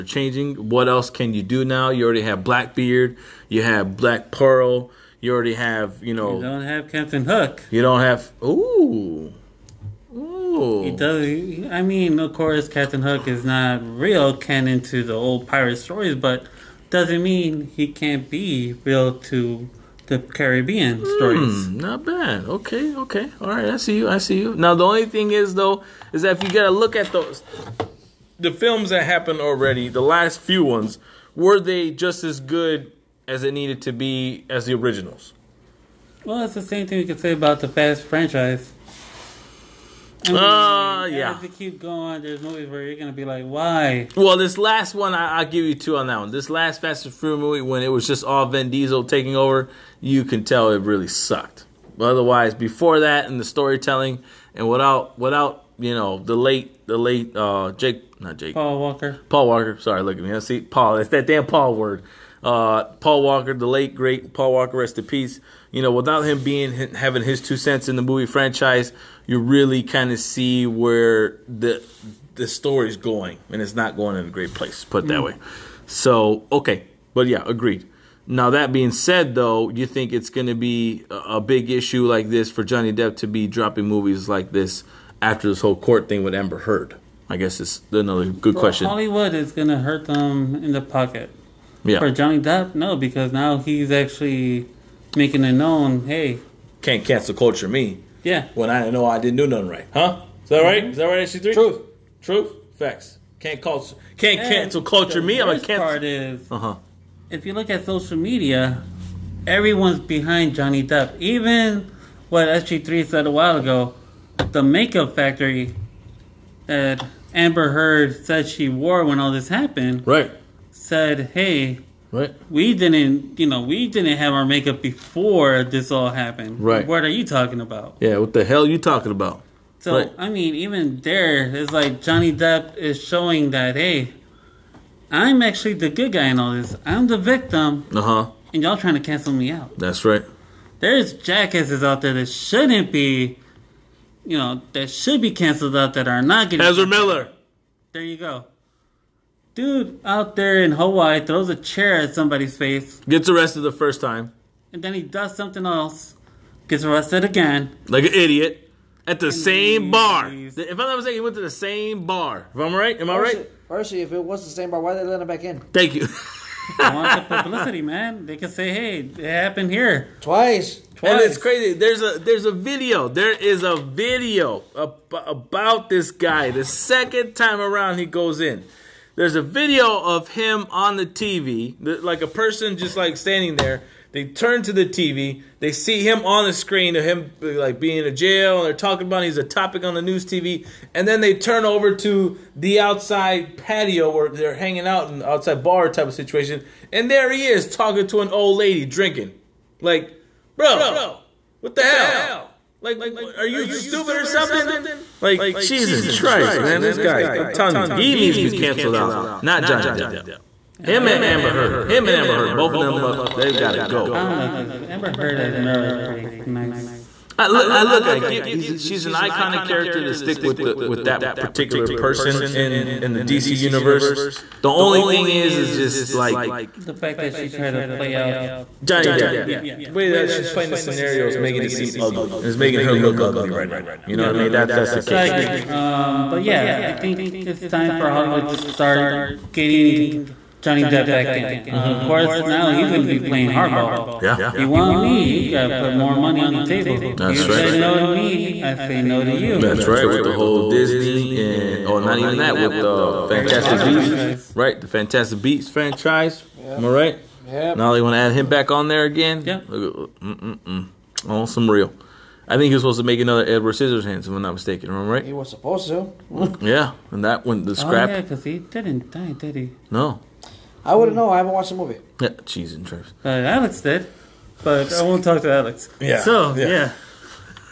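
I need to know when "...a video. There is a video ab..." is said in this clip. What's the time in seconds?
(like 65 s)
172 s.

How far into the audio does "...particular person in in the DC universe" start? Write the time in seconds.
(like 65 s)
221 s.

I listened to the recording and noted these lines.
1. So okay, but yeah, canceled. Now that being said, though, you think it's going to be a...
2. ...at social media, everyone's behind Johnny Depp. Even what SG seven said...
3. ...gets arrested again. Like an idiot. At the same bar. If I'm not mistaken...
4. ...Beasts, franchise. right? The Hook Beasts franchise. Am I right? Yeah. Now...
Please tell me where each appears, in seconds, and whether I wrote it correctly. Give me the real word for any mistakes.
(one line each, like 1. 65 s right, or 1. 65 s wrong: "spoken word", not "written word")
1. 75 s wrong: "agreed", not "canceled"
2. 107 s wrong: "three", not "seven"
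3. 156 s right
4. 253 s wrong: "Fantastic", not "Hook".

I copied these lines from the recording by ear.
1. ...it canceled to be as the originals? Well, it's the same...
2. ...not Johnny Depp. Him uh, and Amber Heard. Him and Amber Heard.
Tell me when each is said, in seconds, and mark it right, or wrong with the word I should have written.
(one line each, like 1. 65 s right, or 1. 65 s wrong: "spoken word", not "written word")
1. 33 s wrong: "needed", not "canceled"
2. 209 s right.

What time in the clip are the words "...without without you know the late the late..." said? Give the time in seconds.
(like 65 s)
54 s.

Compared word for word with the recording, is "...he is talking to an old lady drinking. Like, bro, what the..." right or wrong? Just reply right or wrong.
right.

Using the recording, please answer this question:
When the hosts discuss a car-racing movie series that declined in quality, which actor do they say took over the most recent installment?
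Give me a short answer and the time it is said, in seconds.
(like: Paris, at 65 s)
Vin Diesel, at 48 s.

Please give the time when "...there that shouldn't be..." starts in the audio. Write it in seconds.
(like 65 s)
142 s.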